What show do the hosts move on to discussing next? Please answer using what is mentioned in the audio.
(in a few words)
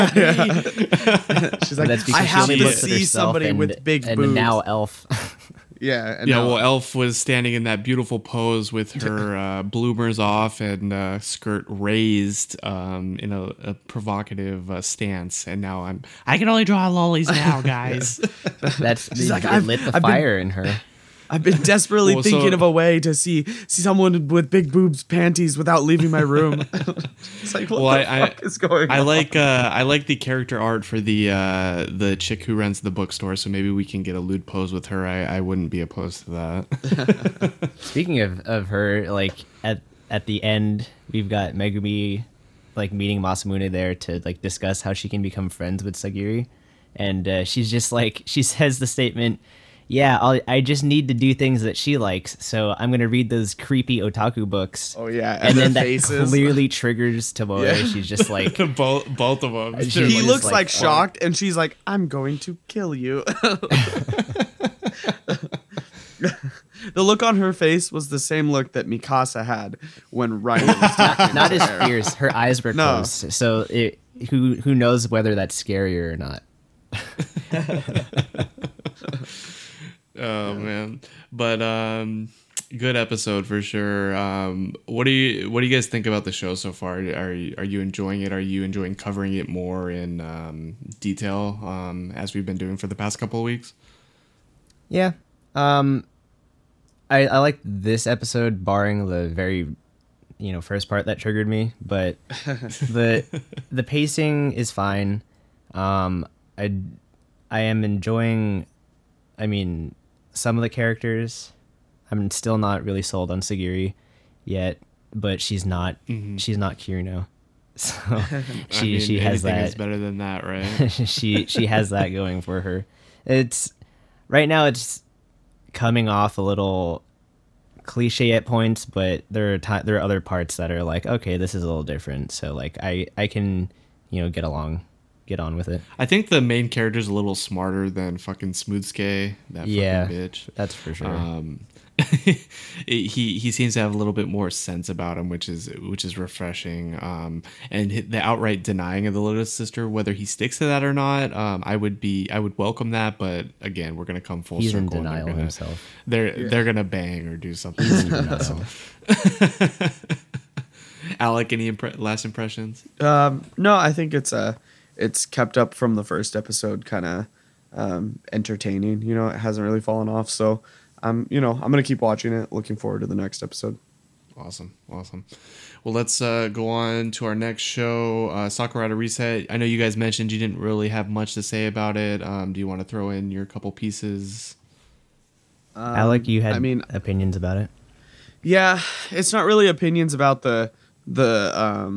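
Sakurada Reset.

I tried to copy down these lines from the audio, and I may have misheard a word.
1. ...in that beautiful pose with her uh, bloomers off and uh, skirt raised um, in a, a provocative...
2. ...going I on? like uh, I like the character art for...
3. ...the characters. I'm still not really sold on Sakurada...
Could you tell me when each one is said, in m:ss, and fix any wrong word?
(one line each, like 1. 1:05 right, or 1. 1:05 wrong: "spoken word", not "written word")
1. 0:07 right
2. 0:28 right
3. 1:50 wrong: "Sagiri", not "Sakurada".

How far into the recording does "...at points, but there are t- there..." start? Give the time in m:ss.
2:08.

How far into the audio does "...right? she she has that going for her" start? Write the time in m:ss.
2:00.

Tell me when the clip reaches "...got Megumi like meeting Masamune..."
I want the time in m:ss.
0:41.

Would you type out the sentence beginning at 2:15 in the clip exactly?
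I think the main character's a little smarter than fucking smoothskay.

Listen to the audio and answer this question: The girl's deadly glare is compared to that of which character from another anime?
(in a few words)
Mikasa.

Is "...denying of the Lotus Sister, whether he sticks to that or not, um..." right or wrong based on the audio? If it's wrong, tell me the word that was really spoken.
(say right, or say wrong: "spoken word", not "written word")
right.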